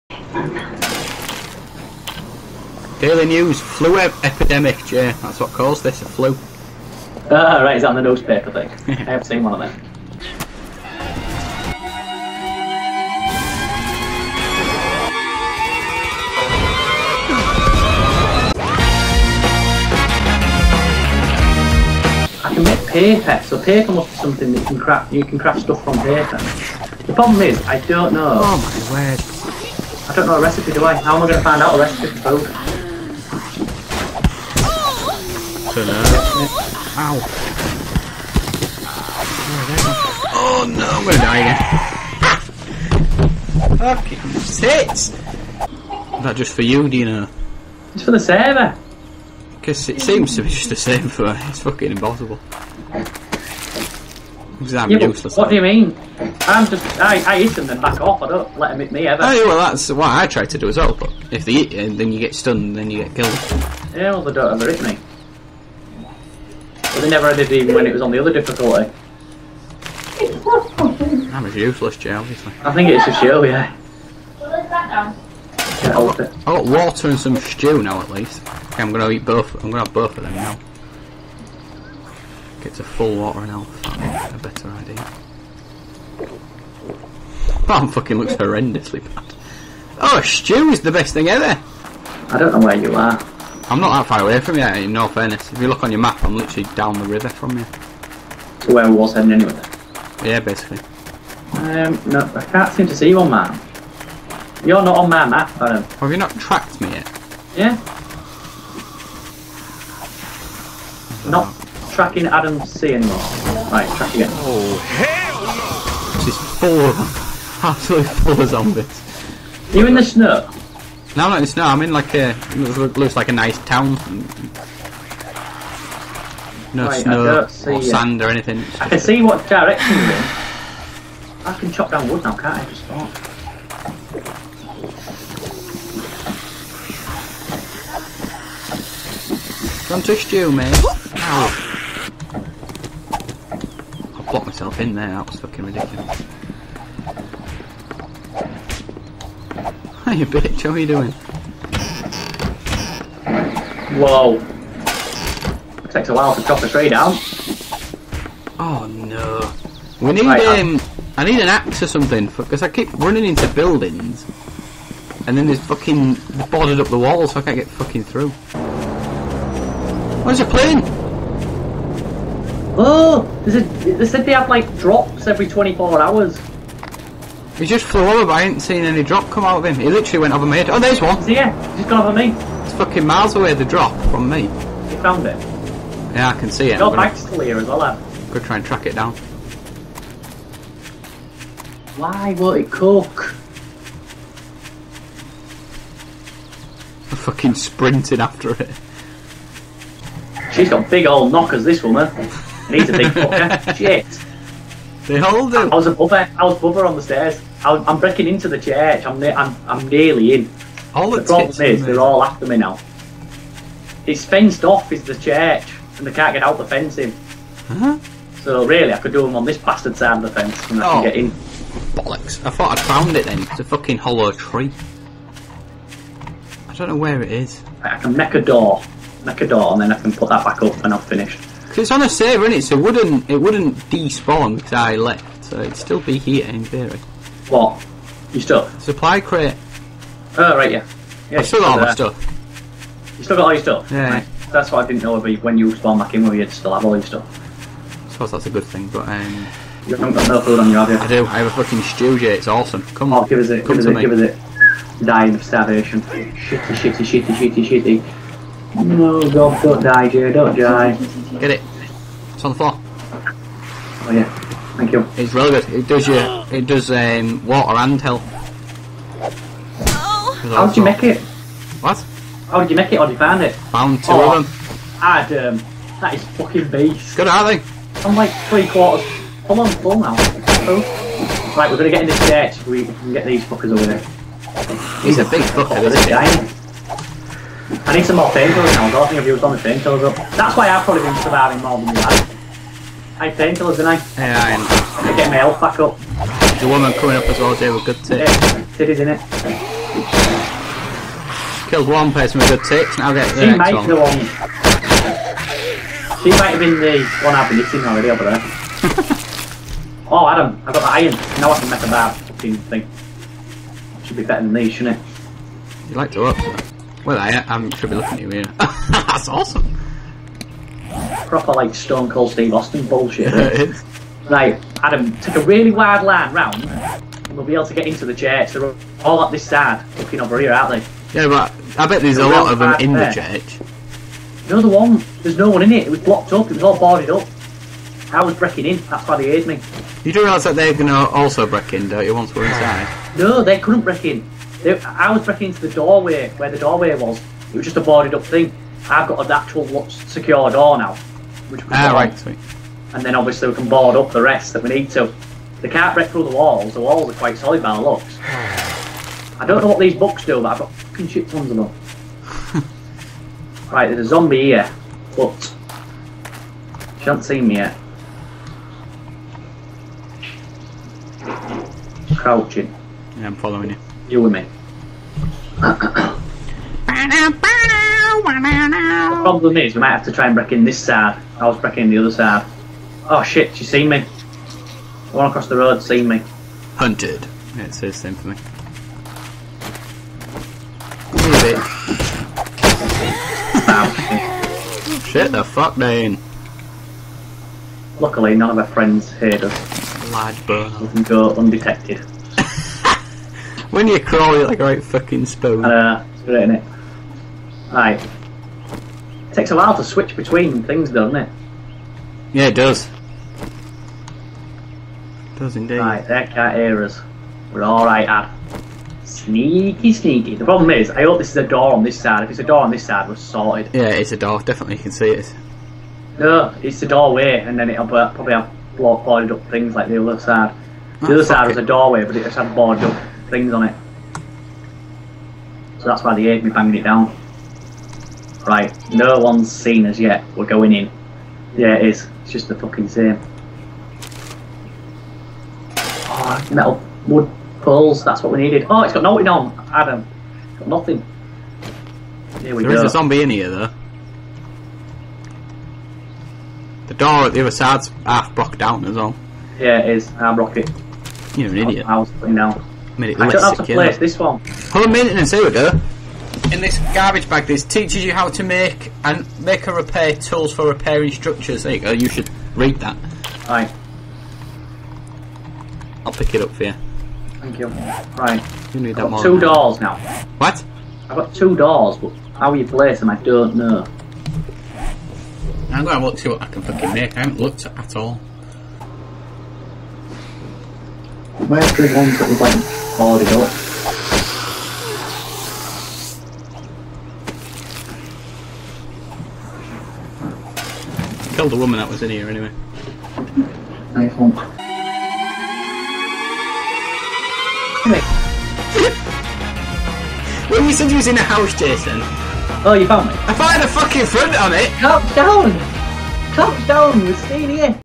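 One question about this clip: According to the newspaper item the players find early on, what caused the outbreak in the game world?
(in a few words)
flu epidemic.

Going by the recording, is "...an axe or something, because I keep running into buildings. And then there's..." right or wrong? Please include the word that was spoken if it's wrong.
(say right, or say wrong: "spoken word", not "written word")
right.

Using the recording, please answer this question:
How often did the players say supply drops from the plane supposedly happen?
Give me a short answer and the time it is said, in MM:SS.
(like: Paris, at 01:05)
every 24 hours, at 02:55.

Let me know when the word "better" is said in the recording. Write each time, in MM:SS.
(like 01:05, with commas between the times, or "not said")
01:24, 05:14.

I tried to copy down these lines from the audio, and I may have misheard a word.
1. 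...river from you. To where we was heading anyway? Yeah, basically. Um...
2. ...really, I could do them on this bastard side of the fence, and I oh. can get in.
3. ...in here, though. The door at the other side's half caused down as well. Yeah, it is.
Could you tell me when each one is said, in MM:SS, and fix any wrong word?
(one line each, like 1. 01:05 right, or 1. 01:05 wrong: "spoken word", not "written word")
1. 01:37 right
2. 03:38 right
3. 07:33 wrong: "blocked", not "caused".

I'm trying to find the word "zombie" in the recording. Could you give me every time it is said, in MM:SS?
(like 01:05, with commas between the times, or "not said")
01:58, 06:04, 07:32.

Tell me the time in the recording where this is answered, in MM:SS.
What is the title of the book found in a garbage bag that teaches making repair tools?
07:44.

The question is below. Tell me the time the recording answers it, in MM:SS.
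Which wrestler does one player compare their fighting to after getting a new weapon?
05:21.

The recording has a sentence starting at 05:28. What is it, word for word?
They're all up this side, looking over here, aren't they?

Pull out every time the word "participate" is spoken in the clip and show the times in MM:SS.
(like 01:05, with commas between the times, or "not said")
not said.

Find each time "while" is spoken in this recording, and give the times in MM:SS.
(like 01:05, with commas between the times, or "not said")
02:36, 06:49.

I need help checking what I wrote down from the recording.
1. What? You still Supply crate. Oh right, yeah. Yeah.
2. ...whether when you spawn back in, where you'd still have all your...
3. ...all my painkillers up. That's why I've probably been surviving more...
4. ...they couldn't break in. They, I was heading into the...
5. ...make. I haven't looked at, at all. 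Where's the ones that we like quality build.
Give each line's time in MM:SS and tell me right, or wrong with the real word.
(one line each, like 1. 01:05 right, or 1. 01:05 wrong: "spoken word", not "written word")
1. 03:57 right
2. 04:05 right
3. 04:49 right
4. 05:43 wrong: "breaking", not "heading"
5. 08:06 right.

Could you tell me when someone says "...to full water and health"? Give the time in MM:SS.
01:22.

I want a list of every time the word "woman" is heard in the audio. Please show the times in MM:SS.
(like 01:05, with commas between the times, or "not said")
03:21, 04:56, 08:21.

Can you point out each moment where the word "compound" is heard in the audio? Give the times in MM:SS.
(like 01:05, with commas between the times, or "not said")
not said.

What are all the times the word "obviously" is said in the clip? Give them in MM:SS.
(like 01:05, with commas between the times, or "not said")
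01:12, 05:53.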